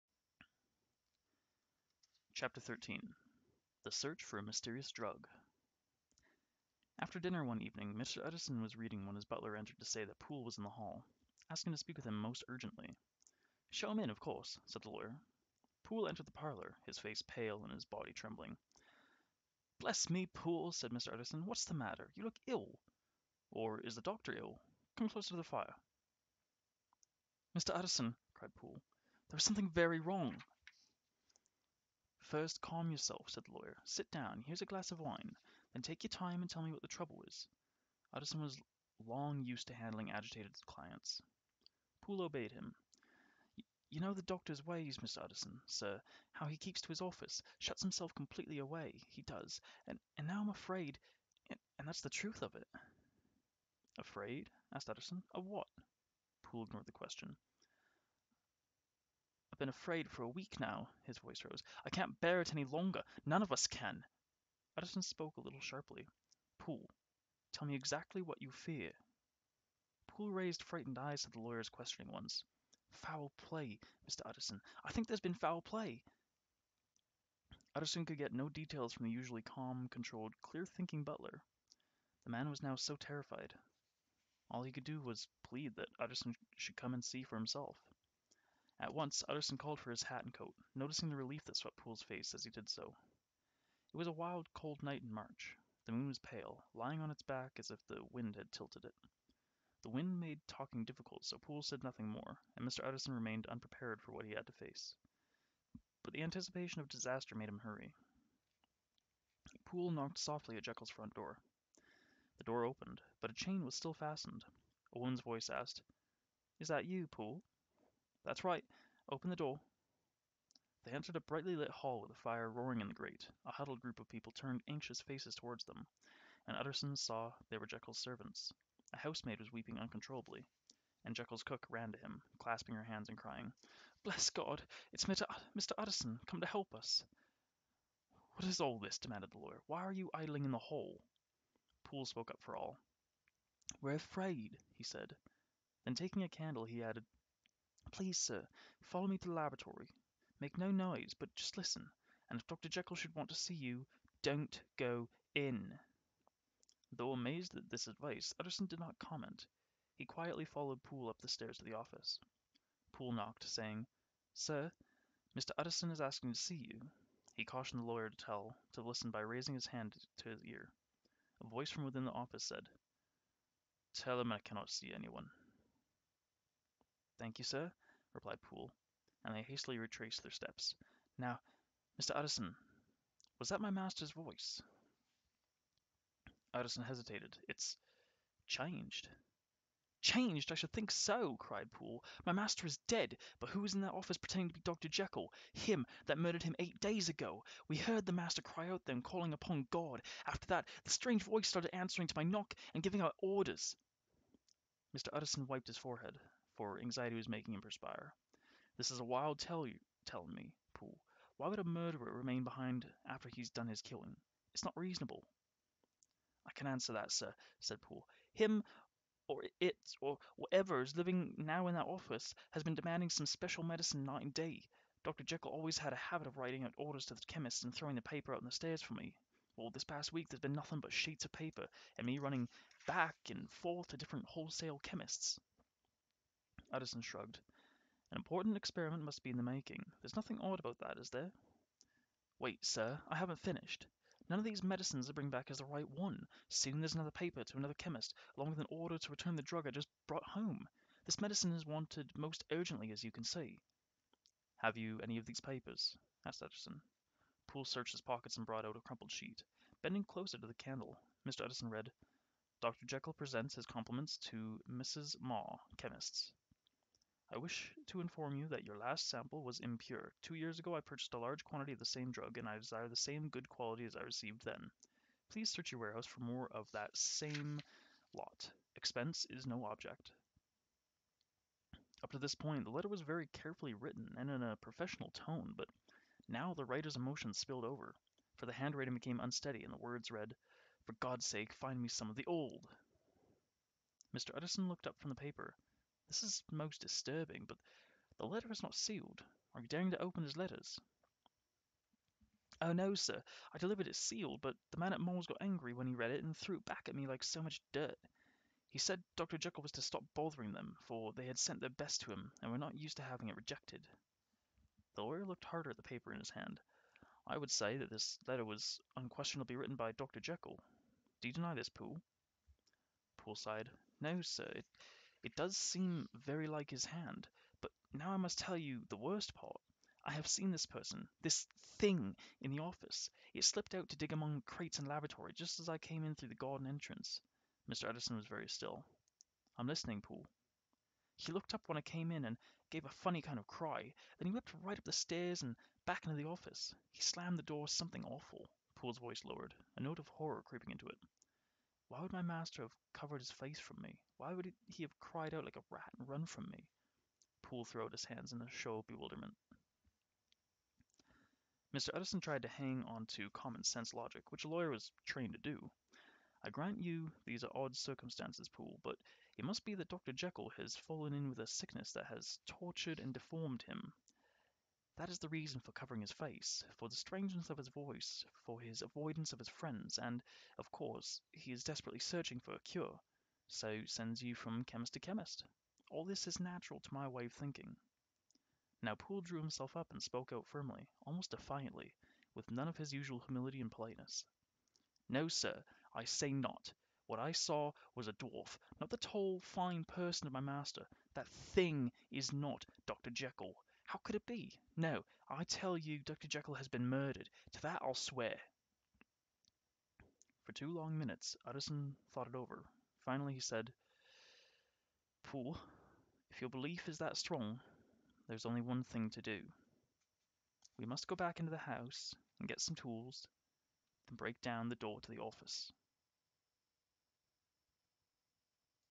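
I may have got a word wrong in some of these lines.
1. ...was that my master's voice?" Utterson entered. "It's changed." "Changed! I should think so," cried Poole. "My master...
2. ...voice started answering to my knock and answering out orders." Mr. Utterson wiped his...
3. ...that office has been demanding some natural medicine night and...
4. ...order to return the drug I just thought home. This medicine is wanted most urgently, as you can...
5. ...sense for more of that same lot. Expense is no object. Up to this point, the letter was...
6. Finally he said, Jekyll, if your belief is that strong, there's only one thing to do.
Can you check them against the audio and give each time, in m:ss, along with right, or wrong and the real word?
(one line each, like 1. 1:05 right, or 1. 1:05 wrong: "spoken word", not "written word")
1. 3:03 wrong: "hesitated", not "entered"
2. 3:21 wrong: "giving", not "answering"
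3. 3:41 wrong: "special", not "natural"
4. 4:08 wrong: "brought", not "thought"
5. 4:35 wrong: "warehouse", not "sense"
6. 6:53 wrong: "Poole", not "Jekyll".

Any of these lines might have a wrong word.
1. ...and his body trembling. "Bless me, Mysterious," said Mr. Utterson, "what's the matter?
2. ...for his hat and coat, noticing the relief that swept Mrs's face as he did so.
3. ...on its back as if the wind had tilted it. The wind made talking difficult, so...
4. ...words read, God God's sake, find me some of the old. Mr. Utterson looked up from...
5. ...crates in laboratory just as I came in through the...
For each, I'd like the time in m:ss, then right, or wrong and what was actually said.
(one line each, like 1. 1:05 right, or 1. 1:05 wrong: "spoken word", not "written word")
1. 0:17 wrong: "Poole", not "Mysterious"
2. 1:29 wrong: "Poole", not "Mrs"
3. 1:36 right
4. 4:49 wrong: "For", not "God"
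5. 5:34 right.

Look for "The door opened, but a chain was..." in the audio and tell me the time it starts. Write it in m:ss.
1:52.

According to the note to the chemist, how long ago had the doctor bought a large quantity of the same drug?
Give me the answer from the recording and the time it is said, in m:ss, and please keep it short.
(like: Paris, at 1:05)
2 years ago, at 4:30.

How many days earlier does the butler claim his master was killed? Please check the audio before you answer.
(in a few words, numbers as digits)
8.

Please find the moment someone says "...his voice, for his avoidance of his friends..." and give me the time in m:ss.
6:17.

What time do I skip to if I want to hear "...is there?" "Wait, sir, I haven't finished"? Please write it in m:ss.
4:00.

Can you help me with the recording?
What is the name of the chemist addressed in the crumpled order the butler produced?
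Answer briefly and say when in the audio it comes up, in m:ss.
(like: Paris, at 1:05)
Mrs. Maw, at 4:24.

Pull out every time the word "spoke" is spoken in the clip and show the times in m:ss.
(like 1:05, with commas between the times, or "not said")
1:05, 2:22, 6:30.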